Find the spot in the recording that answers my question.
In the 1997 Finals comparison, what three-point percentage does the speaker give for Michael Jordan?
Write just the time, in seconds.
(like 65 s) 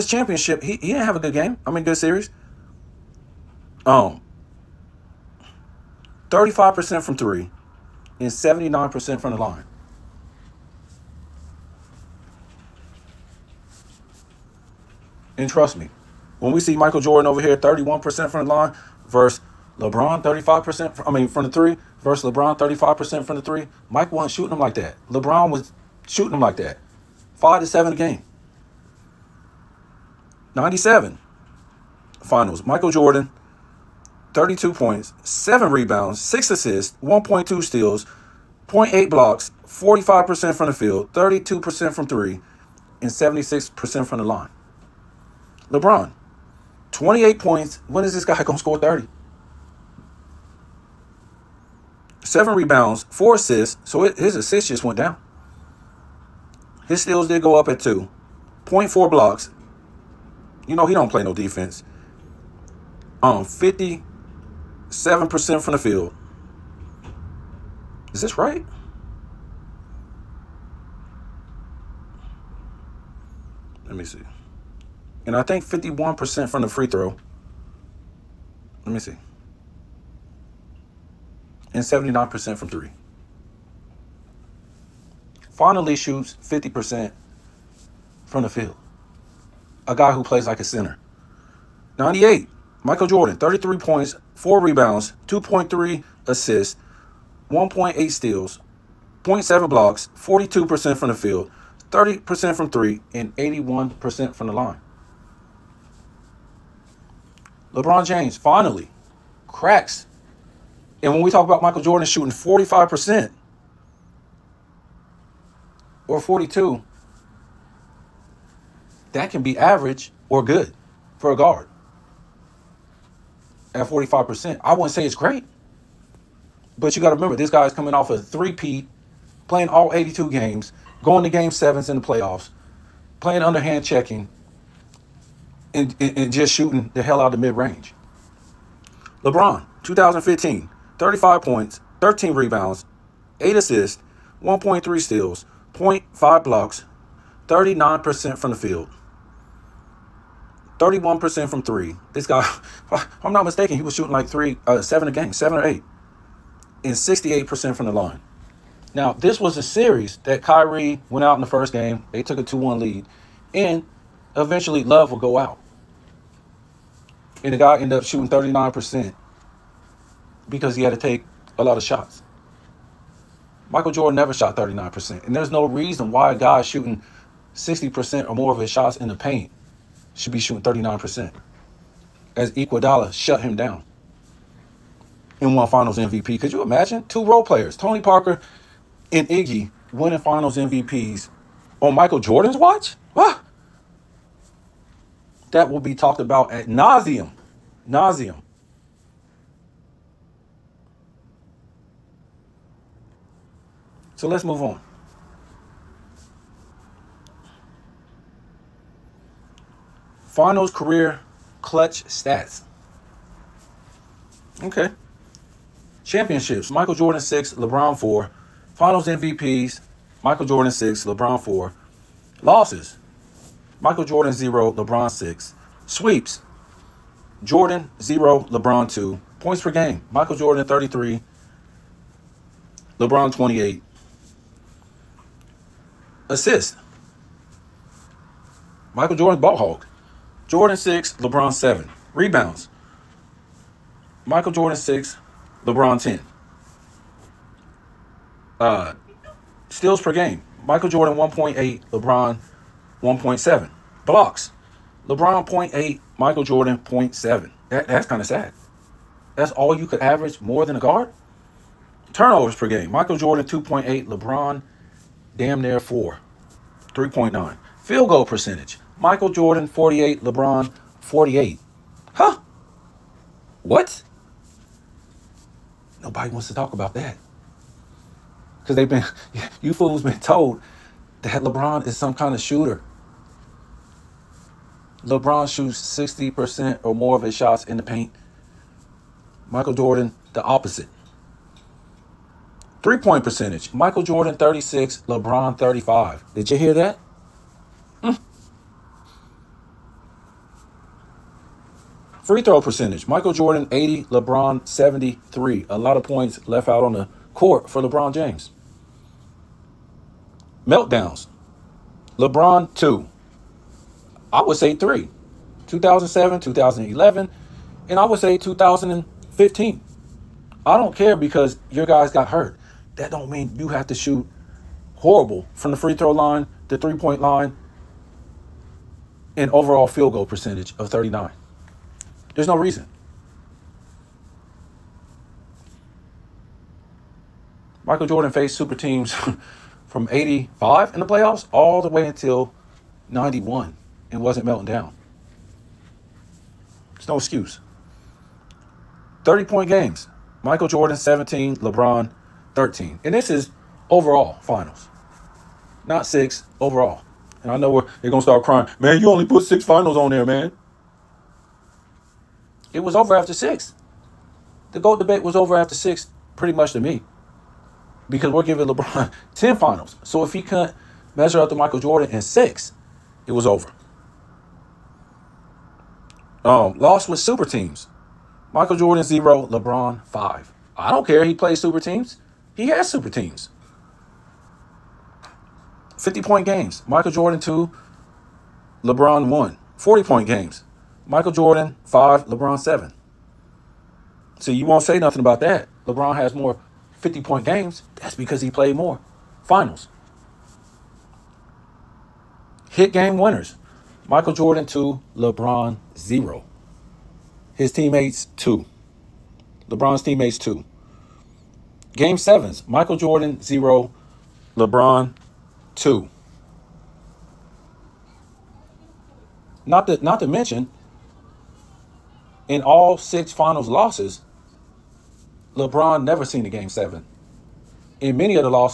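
41 s.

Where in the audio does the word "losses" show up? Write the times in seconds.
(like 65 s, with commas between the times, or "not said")
222 s, 423 s.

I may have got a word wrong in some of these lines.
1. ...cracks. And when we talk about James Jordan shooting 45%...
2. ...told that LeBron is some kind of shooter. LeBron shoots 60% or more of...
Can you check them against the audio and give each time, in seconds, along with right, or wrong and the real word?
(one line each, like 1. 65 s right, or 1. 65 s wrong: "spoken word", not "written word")
1. 109 s wrong: "Michael", not "James"
2. 280 s right.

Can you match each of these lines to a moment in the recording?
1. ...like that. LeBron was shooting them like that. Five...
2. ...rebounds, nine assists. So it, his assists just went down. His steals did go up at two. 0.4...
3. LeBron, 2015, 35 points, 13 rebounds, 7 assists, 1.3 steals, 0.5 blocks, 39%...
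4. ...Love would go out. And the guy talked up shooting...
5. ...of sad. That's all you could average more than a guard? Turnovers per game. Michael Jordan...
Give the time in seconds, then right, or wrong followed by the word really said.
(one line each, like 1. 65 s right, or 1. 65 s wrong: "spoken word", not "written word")
1. 24 s right
2. 52 s wrong: "four", not "nine"
3. 139 s wrong: "8", not "7"
4. 164 s wrong: "ended", not "talked"
5. 258 s right.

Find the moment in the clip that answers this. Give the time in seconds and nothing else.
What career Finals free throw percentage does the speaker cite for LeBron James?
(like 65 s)
304 s.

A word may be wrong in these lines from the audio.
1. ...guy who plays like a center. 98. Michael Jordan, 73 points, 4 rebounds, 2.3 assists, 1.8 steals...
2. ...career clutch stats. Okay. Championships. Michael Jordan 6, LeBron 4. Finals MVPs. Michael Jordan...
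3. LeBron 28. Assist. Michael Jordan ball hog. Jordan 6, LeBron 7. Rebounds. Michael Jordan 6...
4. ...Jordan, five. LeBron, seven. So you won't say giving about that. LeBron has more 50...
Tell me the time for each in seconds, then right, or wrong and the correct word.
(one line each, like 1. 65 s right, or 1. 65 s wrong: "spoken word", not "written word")
1. 89 s wrong: "33", not "73"
2. 210 s right
3. 232 s right
4. 391 s wrong: "nothing", not "giving".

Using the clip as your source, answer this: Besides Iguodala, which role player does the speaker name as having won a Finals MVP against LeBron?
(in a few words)
Tony Parker.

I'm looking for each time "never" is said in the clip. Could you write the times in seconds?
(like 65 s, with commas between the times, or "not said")
174 s, 426 s.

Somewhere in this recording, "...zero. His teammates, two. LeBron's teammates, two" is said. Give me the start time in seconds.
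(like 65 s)
405 s.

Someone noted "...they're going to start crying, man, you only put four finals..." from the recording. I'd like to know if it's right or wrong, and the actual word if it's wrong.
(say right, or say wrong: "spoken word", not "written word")
wrong: "six", not "four".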